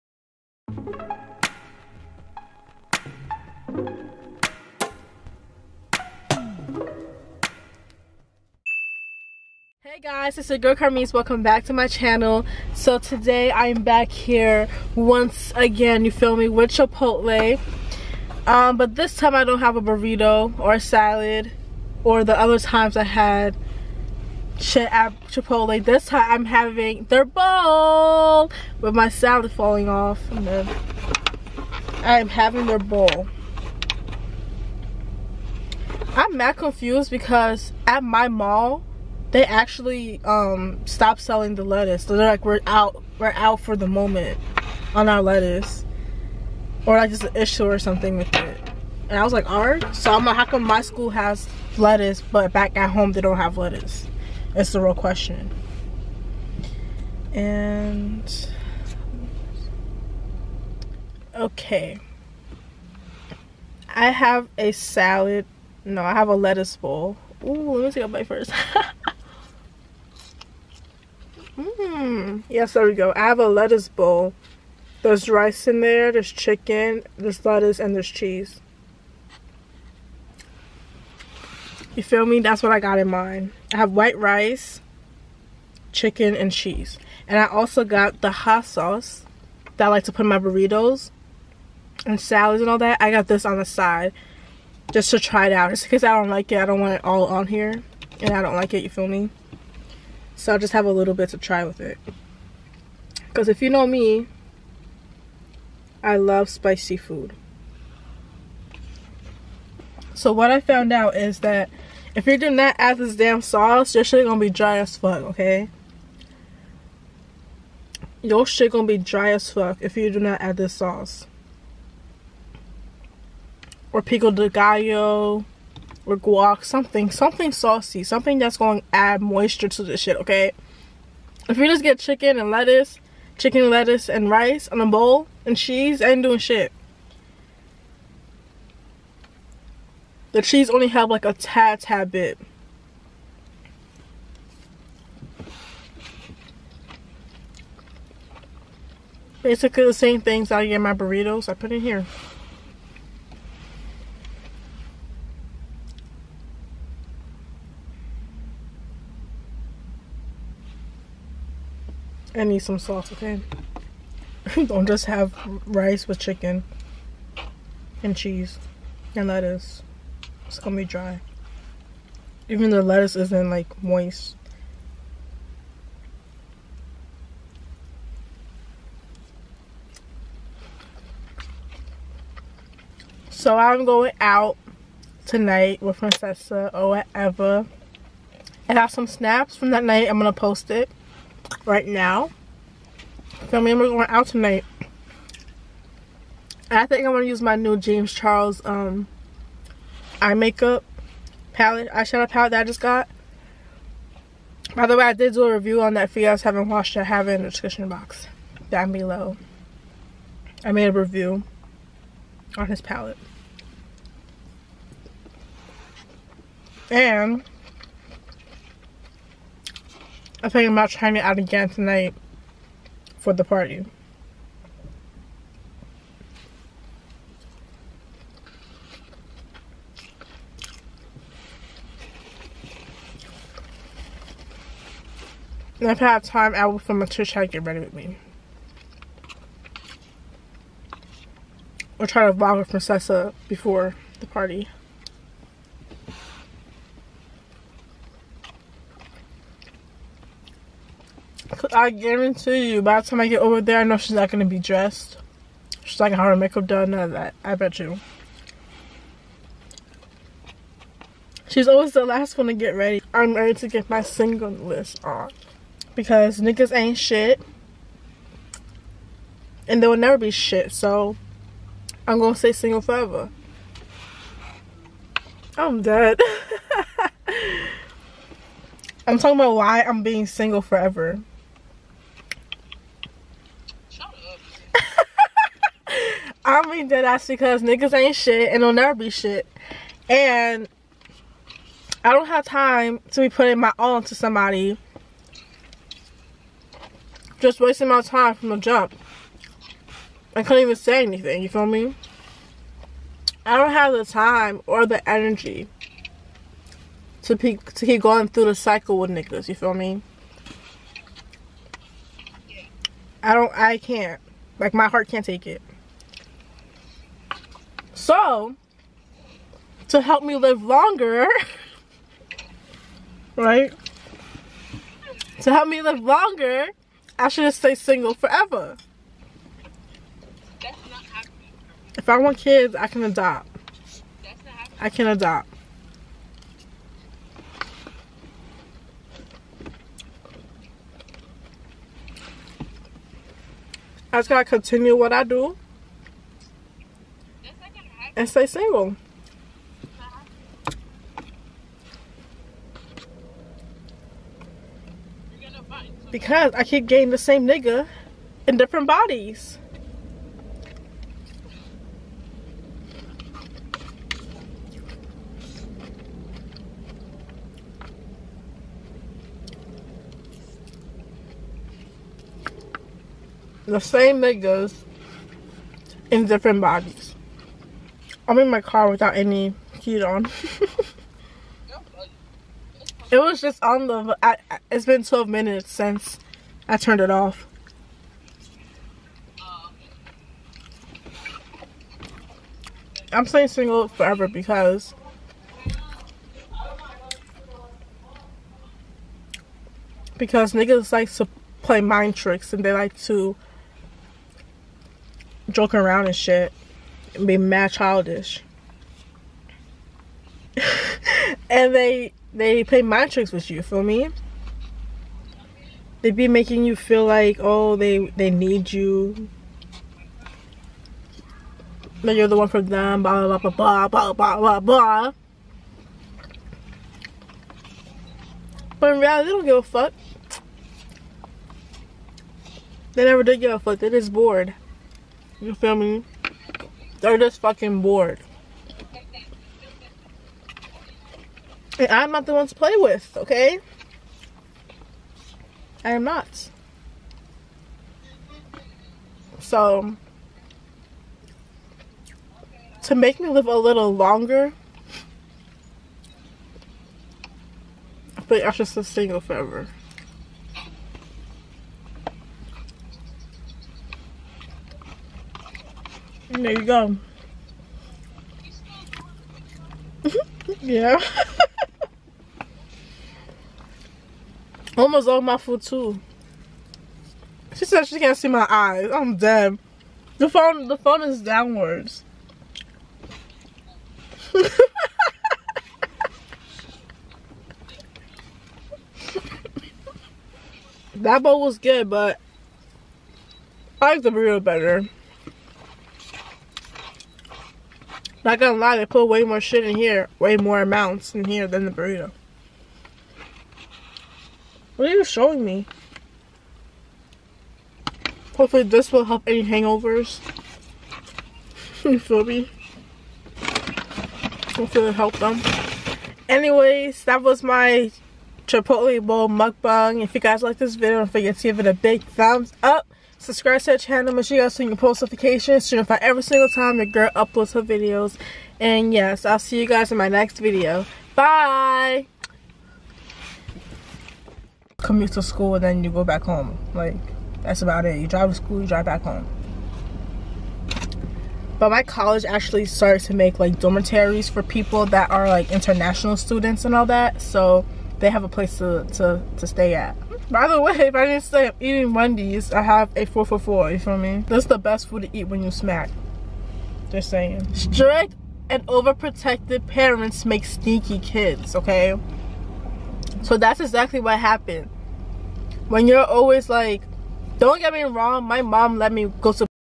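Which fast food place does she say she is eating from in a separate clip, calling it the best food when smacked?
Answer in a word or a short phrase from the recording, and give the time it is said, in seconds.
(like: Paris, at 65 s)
Wendy's, at 551 s.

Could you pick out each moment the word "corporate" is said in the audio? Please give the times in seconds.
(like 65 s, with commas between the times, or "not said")
not said.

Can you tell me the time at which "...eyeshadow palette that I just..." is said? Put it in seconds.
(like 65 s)
201 s.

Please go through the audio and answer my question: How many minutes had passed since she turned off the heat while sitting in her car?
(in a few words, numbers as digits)
12.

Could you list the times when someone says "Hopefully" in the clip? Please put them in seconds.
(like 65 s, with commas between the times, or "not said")
508 s, 514 s.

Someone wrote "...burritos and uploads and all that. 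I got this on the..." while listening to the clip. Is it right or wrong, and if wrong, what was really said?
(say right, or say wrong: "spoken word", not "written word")
wrong: "salads", not "uploads".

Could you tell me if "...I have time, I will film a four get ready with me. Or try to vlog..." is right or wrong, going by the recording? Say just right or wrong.
wrong.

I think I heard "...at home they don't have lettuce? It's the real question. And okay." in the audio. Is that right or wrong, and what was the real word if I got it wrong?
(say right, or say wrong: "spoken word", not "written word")
right.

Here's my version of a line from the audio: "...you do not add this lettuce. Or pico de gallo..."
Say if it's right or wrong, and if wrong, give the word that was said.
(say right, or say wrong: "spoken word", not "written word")
wrong: "sauce", not "lettuce".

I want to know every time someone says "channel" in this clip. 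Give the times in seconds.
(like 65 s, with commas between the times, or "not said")
11 s, 523 s.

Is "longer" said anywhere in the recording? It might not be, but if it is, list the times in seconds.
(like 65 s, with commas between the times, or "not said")
320 s, 326 s, 453 s.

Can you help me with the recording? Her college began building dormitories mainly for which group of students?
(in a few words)
International students.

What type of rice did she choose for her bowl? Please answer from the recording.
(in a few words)
White rice.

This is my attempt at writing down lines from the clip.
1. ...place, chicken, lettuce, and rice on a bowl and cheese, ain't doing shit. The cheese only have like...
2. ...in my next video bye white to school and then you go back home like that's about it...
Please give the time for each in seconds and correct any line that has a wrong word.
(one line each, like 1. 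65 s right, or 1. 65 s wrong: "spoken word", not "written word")
1. 132 s wrong: "lettuce", not "place"
2. 529 s wrong: "commute", not "white".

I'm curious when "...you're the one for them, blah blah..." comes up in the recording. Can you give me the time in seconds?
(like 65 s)
422 s.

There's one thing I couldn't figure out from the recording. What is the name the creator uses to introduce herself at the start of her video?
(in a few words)
Carmise.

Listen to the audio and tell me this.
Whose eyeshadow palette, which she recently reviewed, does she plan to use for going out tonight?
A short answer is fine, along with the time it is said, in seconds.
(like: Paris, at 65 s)
James Charles, at 197 s.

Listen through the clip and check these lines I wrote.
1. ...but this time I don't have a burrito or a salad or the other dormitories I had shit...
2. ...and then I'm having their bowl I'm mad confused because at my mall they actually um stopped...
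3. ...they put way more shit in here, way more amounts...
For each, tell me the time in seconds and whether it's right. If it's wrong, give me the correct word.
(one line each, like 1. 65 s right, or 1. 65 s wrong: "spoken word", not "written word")
1. 18 s wrong: "times", not "dormitories"
2. 30 s right
3. 498 s right.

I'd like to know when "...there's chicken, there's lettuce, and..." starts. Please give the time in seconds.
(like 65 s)
76 s.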